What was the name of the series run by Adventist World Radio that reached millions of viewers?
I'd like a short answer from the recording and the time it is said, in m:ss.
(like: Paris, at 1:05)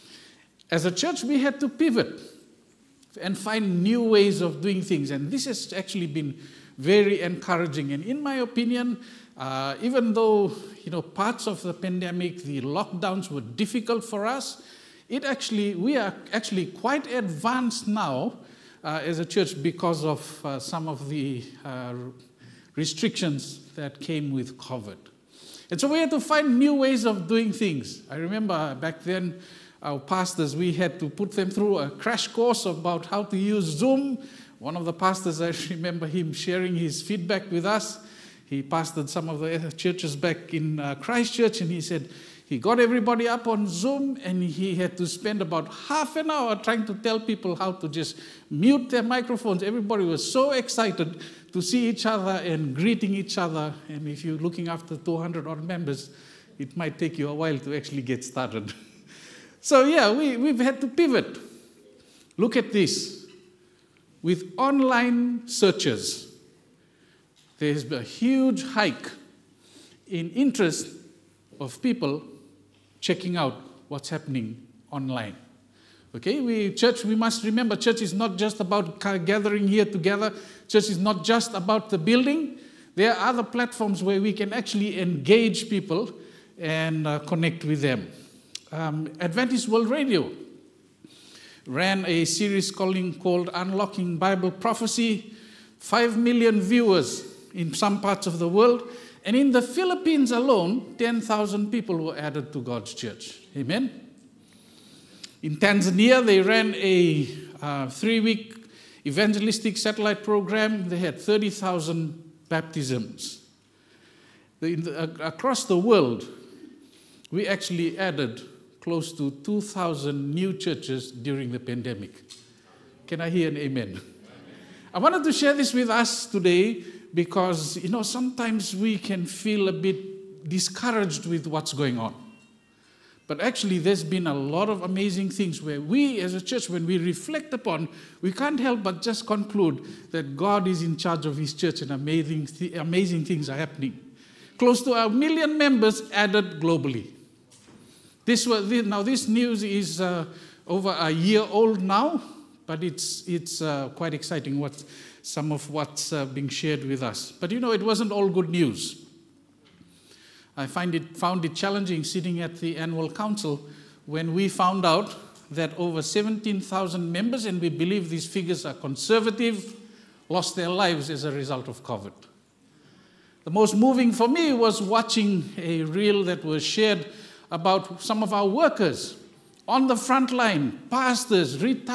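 Unlocking Bible Prophecy, at 1:33.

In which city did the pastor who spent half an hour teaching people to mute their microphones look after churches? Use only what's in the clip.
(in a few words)
Christchurch.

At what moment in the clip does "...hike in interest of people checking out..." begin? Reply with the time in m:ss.
1:08.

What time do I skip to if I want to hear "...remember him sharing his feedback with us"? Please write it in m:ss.
0:35.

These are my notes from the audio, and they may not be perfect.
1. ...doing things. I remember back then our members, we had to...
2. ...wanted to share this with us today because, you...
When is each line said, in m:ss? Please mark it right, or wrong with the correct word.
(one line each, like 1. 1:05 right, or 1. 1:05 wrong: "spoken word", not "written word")
1. 0:27 wrong: "pastors", not "members"
2. 2:04 right.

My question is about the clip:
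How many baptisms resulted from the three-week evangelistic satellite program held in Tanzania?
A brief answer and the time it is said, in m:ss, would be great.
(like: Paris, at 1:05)
30,000, at 1:51.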